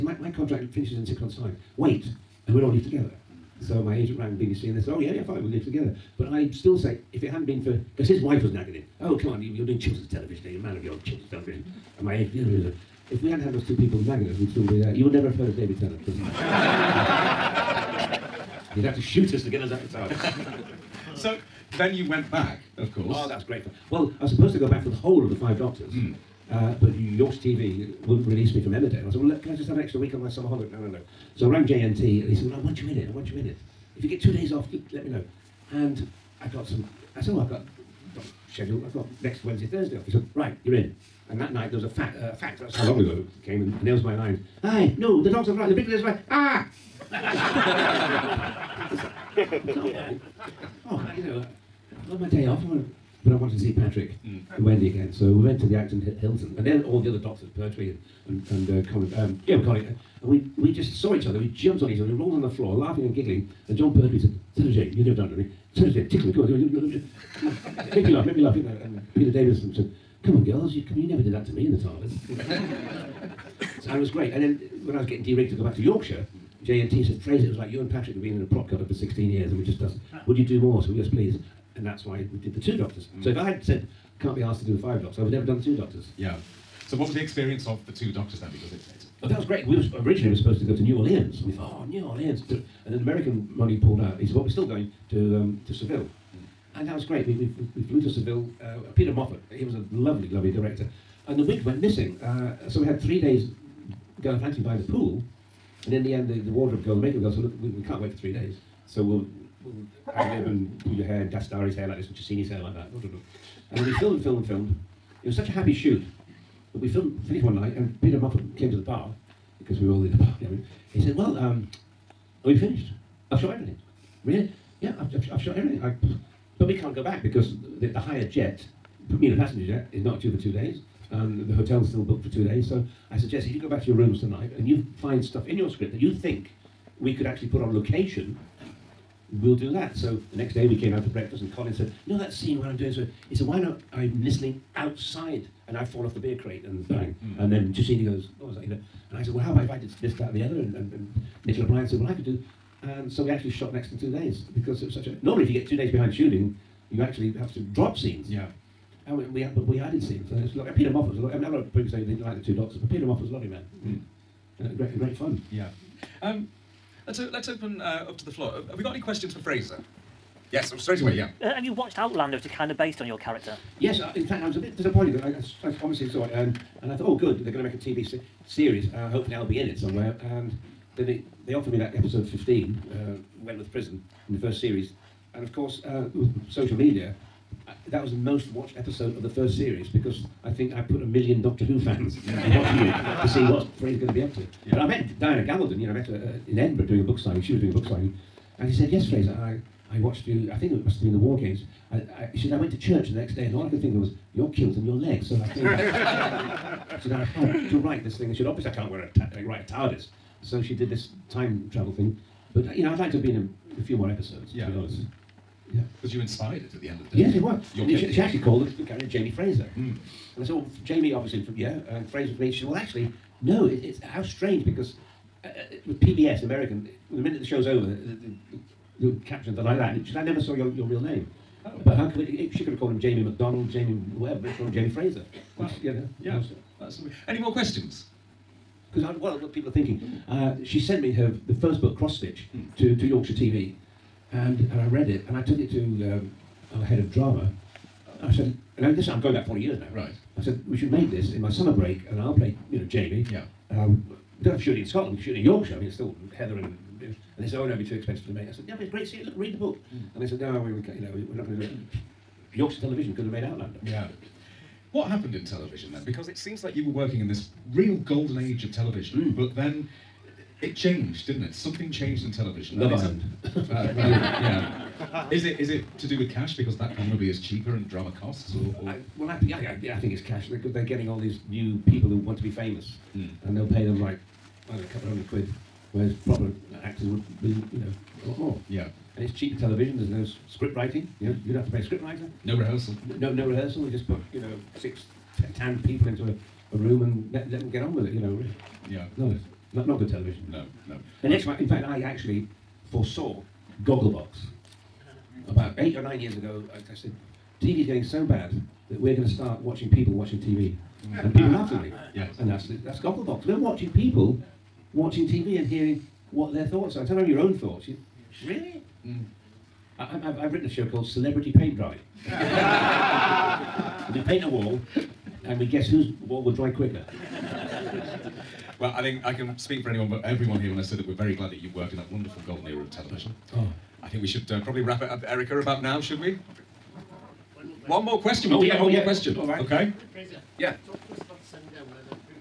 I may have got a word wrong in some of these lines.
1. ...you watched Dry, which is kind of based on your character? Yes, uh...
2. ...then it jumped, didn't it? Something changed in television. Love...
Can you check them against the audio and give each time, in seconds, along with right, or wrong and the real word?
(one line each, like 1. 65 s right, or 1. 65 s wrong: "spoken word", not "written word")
1. 171 s wrong: "Outlander", not "Dry"
2. 269 s wrong: "changed", not "jumped".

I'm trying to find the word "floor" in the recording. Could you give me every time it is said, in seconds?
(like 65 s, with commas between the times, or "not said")
62 s, 168 s.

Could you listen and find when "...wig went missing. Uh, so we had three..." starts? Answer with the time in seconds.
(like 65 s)
101 s.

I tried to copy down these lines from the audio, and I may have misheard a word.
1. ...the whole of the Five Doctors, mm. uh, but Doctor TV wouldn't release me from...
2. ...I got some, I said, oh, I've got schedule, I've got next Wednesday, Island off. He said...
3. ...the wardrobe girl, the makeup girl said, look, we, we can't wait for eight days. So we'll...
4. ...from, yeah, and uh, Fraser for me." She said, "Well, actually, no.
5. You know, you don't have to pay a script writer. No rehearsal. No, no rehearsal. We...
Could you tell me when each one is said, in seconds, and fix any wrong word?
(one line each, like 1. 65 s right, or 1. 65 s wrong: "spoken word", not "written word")
1. 24 s wrong: "Yorkshire", not "Doctor"
2. 36 s wrong: "Thursday", not "Island"
3. 106 s wrong: "three", not "eight"
4. 221 s right
5. 291 s right.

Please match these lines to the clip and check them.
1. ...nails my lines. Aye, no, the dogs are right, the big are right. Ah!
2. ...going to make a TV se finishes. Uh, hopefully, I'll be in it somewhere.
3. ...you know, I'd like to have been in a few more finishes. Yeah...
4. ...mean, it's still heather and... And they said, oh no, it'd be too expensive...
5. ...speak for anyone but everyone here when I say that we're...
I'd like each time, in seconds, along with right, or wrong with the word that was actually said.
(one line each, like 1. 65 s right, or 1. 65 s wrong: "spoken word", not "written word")
1. 43 s right
2. 177 s wrong: "series", not "finishes"
3. 212 s wrong: "episodes", not "finishes"
4. 255 s right
5. 329 s right.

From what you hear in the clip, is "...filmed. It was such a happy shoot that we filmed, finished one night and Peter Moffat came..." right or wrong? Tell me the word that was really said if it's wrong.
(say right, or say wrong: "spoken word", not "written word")
right.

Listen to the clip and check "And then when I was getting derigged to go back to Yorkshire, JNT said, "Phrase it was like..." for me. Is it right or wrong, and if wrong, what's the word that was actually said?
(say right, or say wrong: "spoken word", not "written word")
right.